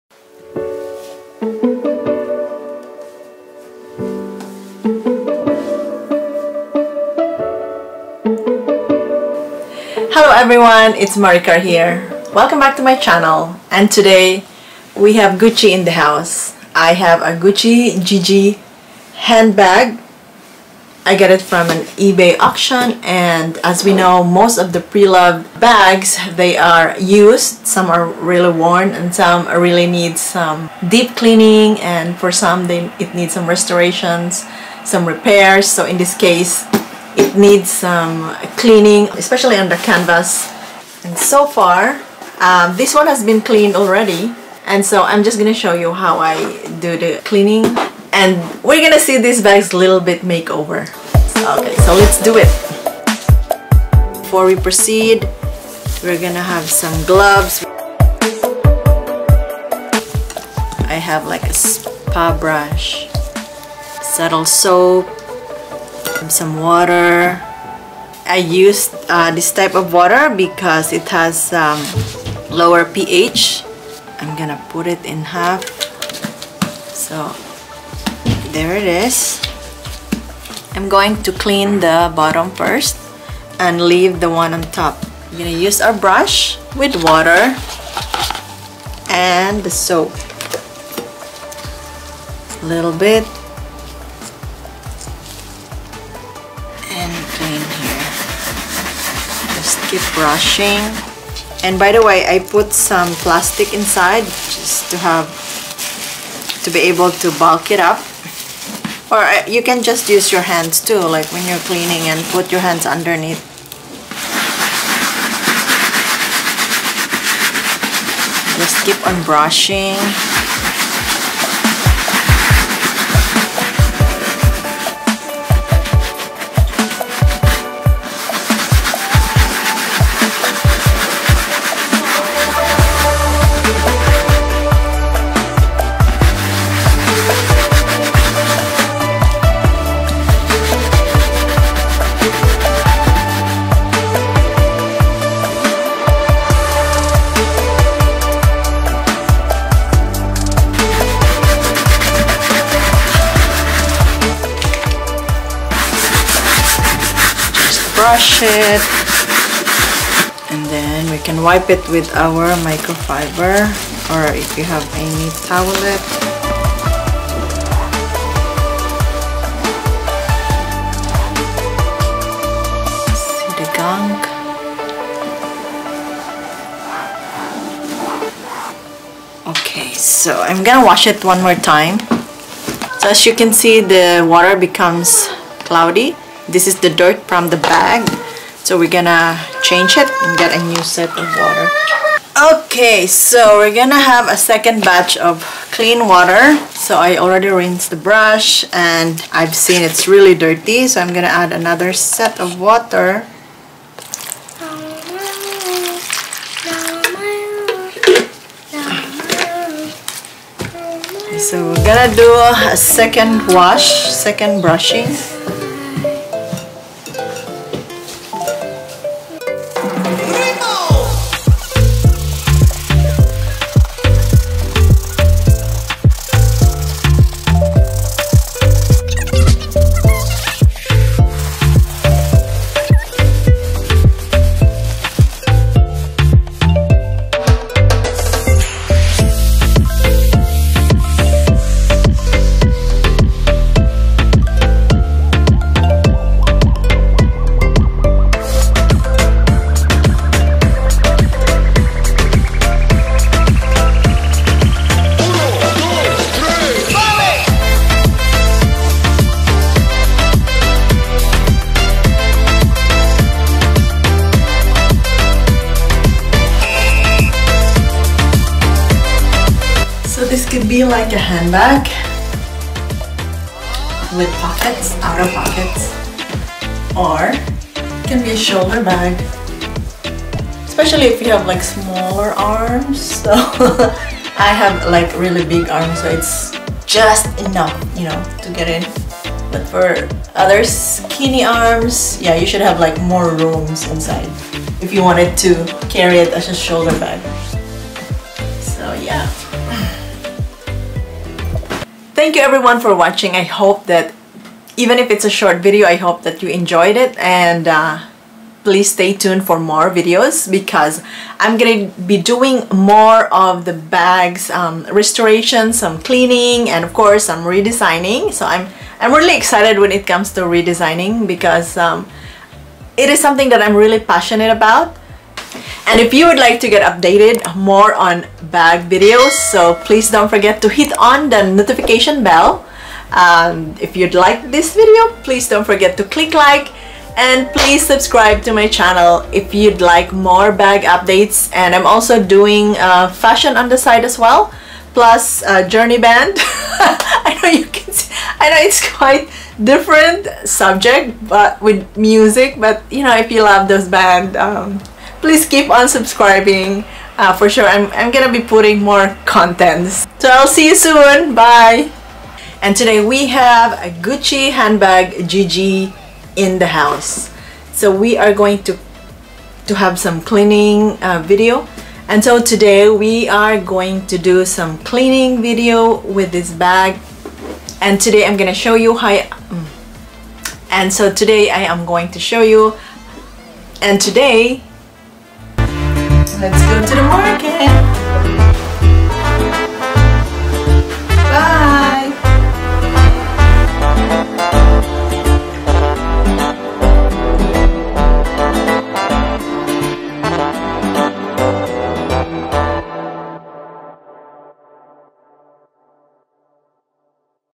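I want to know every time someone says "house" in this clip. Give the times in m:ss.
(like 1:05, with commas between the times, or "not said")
0:15, 6:06.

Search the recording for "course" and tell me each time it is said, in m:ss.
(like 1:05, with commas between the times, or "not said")
5:16.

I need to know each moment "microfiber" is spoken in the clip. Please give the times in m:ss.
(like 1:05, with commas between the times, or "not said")
2:42.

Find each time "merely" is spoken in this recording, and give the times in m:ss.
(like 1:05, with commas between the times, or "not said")
not said.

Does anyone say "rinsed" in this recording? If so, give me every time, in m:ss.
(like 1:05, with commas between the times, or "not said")
3:17.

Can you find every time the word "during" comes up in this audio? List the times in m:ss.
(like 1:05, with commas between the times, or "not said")
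not said.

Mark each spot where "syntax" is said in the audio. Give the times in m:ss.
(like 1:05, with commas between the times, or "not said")
not said.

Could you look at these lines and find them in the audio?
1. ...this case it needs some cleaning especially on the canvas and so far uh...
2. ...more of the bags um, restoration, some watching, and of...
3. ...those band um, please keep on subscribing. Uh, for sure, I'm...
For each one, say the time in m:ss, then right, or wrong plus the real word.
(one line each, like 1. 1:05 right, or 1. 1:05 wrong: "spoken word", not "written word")
1. 0:35 right
2. 5:12 wrong: "cleaning", not "watching"
3. 5:53 right.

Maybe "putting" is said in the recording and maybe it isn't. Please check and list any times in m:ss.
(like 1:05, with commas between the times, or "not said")
5:58.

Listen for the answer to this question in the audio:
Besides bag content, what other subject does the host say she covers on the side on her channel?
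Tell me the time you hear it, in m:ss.
5:43.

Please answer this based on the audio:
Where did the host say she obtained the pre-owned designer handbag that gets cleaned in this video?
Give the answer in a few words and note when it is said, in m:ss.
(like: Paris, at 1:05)
eBay auction, at 0:21.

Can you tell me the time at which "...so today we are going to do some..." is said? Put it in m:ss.
6:12.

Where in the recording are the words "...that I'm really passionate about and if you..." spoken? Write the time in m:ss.
5:23.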